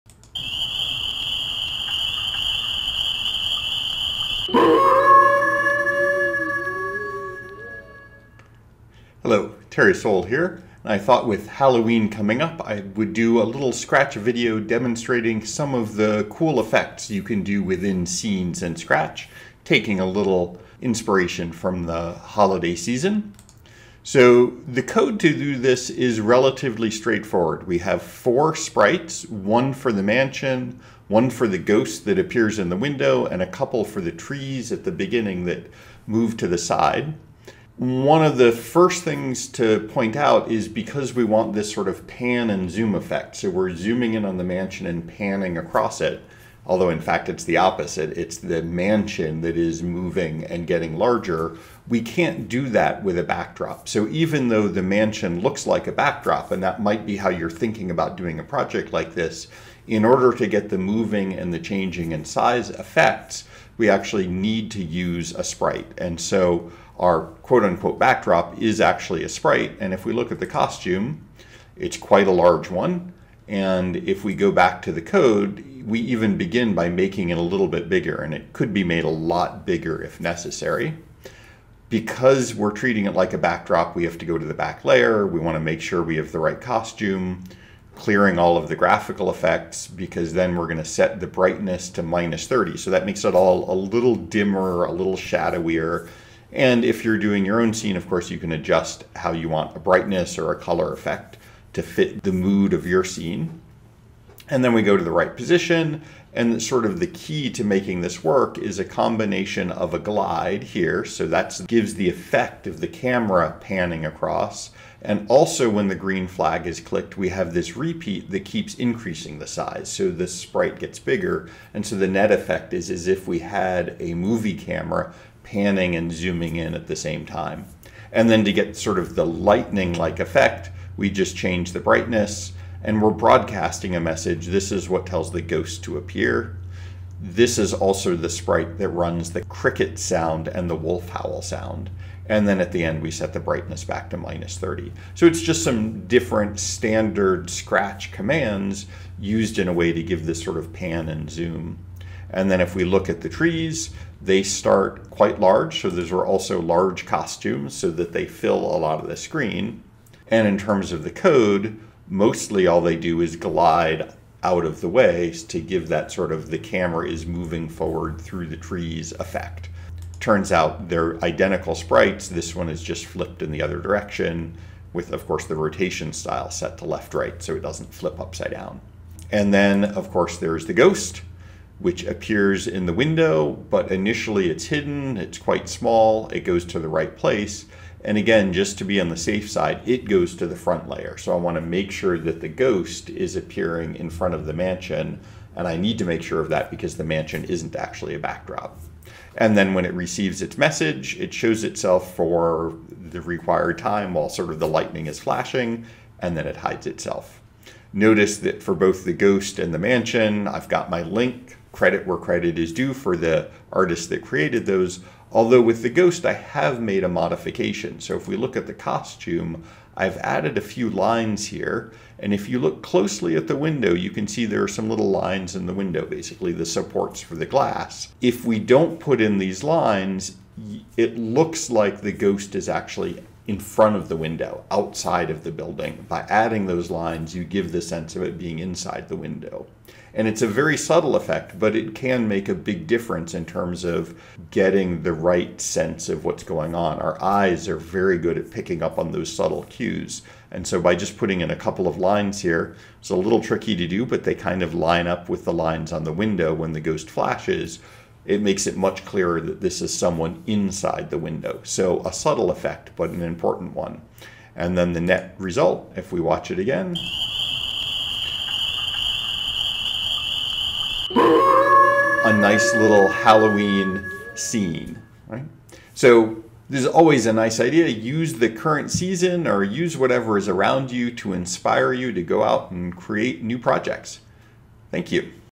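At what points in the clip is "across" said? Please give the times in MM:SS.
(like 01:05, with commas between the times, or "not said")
00:45, 01:54.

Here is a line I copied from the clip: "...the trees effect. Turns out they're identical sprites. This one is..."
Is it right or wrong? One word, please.
right.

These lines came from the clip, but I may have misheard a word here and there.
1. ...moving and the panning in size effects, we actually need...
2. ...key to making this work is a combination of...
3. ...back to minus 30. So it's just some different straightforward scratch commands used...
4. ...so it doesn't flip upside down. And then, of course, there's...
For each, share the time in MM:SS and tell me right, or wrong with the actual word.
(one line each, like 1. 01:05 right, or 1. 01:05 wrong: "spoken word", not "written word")
1. 01:00 wrong: "changing", not "panning"
2. 01:47 right
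3. 02:23 wrong: "standard", not "straightforward"
4. 02:57 right.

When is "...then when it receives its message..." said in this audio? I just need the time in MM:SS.
03:19.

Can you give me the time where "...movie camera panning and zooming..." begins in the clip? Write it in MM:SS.
02:04.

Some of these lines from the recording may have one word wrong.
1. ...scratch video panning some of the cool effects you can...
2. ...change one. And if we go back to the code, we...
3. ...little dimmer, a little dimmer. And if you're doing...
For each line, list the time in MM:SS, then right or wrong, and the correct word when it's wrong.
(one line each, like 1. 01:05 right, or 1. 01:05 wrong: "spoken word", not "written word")
1. 00:13 wrong: "demonstrating", not "panning"
2. 01:12 wrong: "large", not "change"
3. 01:33 wrong: "shadowier", not "dimmer".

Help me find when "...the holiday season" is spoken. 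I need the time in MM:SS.
00:21.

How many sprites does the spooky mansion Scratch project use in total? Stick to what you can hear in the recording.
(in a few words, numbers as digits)
4.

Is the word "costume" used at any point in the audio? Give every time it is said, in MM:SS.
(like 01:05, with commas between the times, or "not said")
01:10, 01:26, 02:37, 03:38.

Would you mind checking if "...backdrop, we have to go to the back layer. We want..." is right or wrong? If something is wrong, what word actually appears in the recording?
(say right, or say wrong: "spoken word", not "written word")
right.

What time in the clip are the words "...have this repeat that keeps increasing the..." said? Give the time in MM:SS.
01:57.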